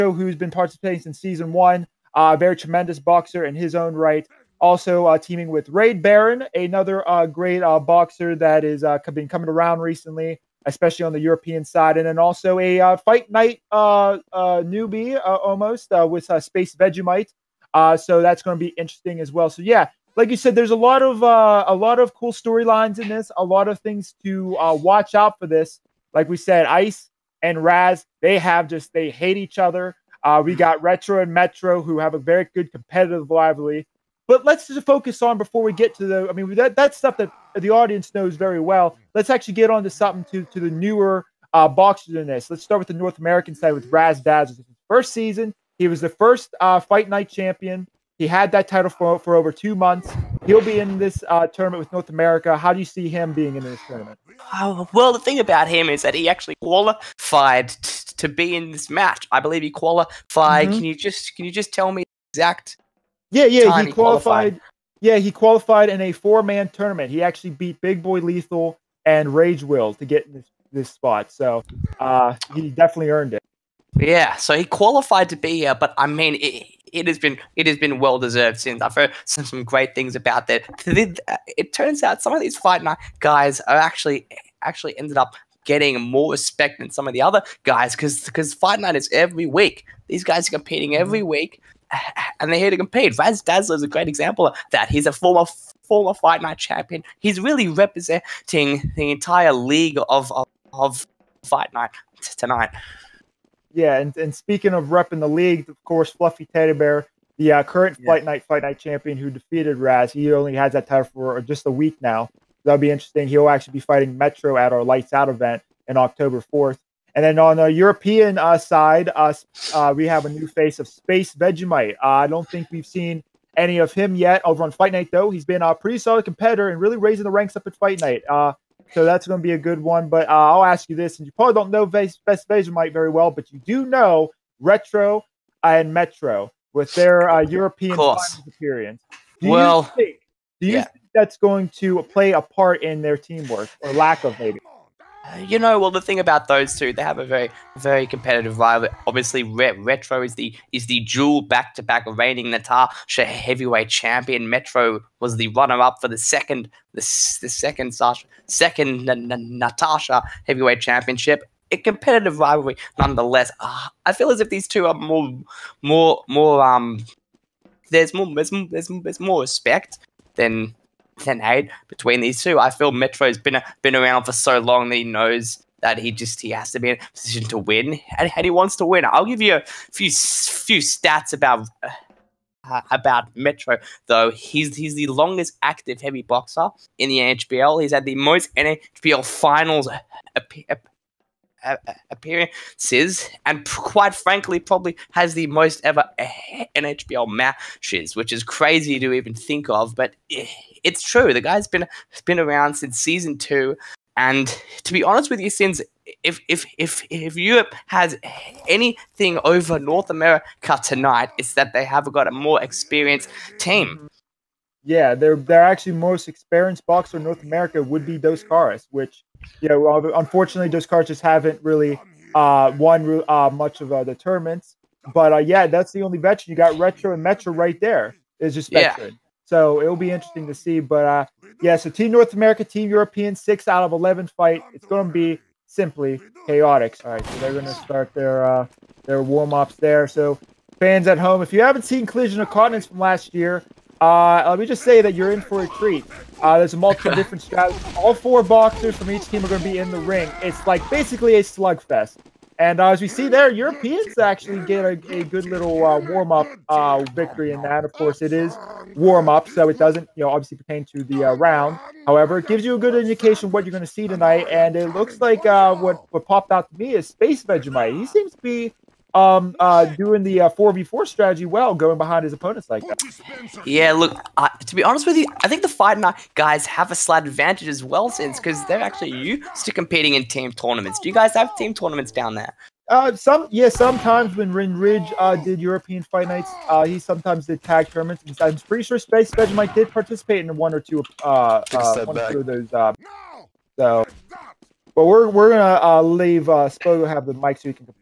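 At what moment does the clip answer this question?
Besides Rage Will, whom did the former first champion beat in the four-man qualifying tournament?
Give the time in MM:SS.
01:07.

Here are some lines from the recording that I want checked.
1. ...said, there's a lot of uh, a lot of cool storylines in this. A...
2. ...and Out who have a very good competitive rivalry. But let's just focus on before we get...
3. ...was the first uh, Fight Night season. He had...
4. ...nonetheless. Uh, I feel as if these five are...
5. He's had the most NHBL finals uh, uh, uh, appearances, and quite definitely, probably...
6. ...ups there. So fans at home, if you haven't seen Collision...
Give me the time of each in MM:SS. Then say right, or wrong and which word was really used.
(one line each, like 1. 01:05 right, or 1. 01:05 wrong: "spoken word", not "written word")
1. 00:20 right
2. 00:31 wrong: "Metro", not "Out"
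3. 00:45 wrong: "champion", not "season"
4. 02:42 wrong: "two", not "five"
5. 03:07 wrong: "frankly", not "definitely"
6. 03:59 right.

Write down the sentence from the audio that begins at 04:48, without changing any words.
I'm pretty sure Space Vegemite did participate in one or two uh, uh one or two of those.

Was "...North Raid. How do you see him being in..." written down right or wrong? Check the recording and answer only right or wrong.
wrong.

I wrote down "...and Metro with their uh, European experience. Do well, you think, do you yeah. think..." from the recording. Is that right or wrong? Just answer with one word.
right.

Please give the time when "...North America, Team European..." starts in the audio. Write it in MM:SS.
03:52.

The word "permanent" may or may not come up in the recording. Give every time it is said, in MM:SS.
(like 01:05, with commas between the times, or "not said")
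not said.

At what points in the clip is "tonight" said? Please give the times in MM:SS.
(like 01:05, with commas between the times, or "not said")
01:42, 03:30, 04:24.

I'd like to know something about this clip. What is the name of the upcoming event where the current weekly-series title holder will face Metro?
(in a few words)
Lights Out.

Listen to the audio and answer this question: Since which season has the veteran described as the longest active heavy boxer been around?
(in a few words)
season 2.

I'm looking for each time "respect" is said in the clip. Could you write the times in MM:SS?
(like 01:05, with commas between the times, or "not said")
01:26, 02:49.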